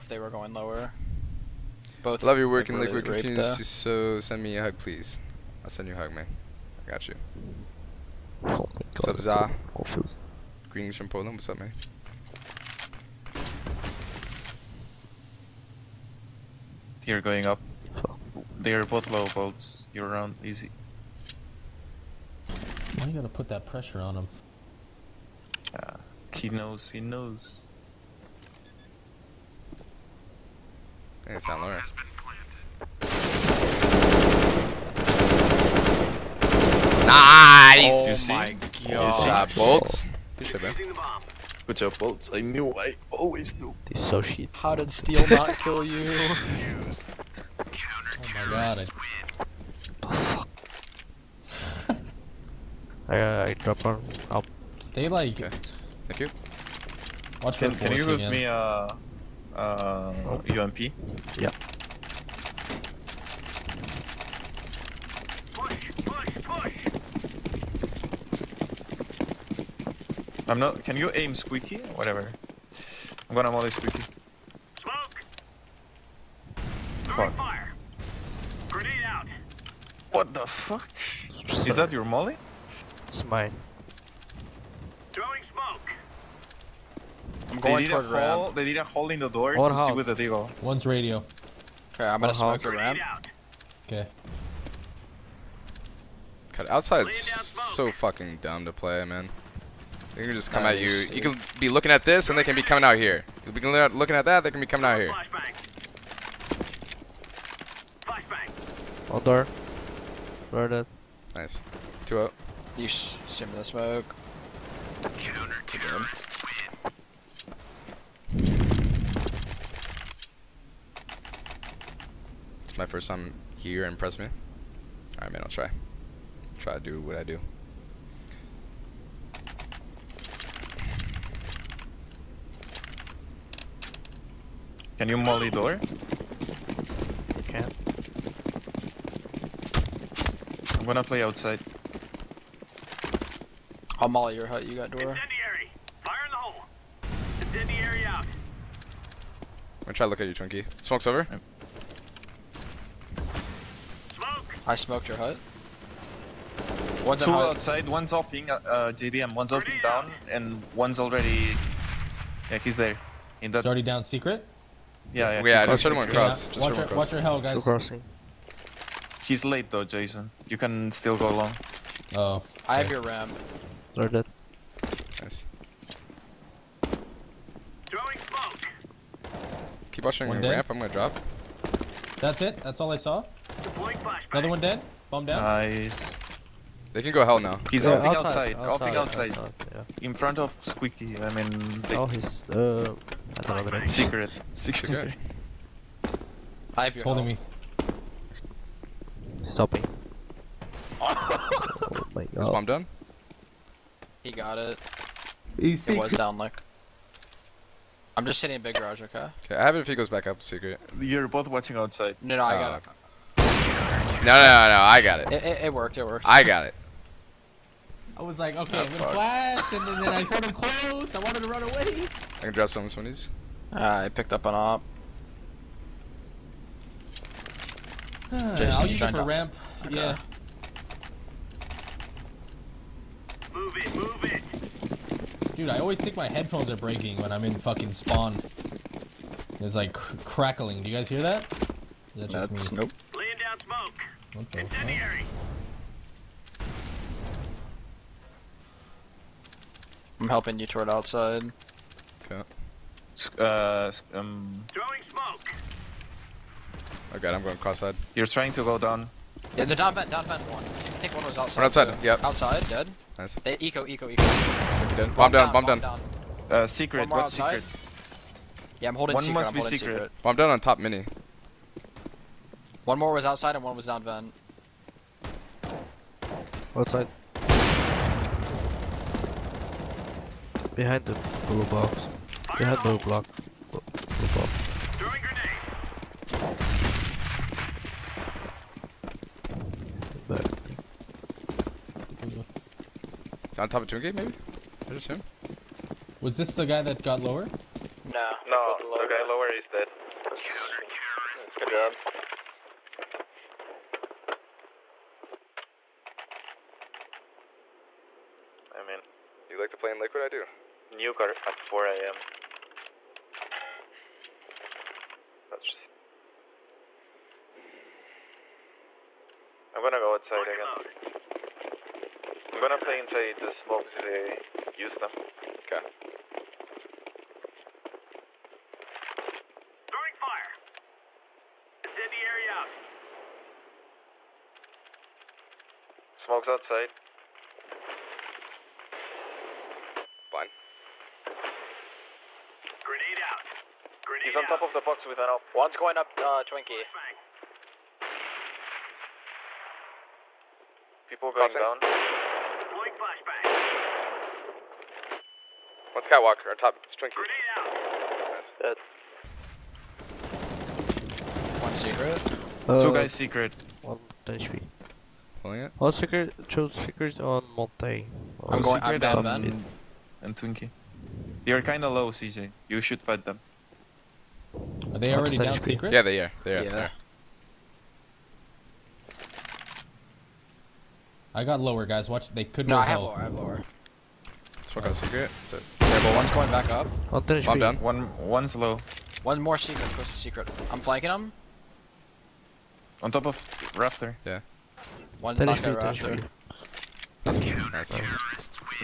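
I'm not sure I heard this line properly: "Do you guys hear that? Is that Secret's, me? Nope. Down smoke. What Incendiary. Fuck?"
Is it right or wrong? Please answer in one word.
wrong.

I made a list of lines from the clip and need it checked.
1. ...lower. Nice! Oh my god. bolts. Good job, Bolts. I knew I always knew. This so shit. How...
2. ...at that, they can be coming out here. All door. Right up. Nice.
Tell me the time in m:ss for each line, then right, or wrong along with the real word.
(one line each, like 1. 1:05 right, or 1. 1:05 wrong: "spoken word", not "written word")
1. 0:31 right
2. 1:44 right.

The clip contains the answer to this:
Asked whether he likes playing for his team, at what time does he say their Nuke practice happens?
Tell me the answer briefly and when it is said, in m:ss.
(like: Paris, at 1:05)
4 a.m., at 5:10.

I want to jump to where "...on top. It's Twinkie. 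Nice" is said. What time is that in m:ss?
5:56.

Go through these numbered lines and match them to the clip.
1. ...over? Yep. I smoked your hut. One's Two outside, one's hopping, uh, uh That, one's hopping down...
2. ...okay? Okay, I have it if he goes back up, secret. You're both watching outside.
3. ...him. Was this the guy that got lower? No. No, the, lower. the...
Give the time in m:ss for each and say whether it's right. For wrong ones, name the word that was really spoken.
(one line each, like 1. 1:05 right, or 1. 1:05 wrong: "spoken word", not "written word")
1. 2:31 wrong: "JDM", not "That"
2. 3:29 right
3. 4:55 right.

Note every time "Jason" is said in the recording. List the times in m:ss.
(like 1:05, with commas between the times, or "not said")
2:49, 3:48.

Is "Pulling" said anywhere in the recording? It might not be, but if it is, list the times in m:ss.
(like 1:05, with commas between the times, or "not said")
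6:05.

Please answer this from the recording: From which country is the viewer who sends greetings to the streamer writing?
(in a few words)
Poland.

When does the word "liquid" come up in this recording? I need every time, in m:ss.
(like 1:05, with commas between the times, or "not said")
0:02, 5:09.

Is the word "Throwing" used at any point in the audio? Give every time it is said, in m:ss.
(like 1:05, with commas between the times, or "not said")
2:57, 4:14, 5:29.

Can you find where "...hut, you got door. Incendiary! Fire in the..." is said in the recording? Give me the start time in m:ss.
2:24.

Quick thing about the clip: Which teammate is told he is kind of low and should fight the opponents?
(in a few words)
CJ.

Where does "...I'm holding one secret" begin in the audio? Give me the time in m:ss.
4:28.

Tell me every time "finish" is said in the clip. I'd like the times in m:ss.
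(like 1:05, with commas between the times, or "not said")
6:27.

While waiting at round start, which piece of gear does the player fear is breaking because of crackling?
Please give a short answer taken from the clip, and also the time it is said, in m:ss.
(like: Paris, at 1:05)
headphones, at 3:56.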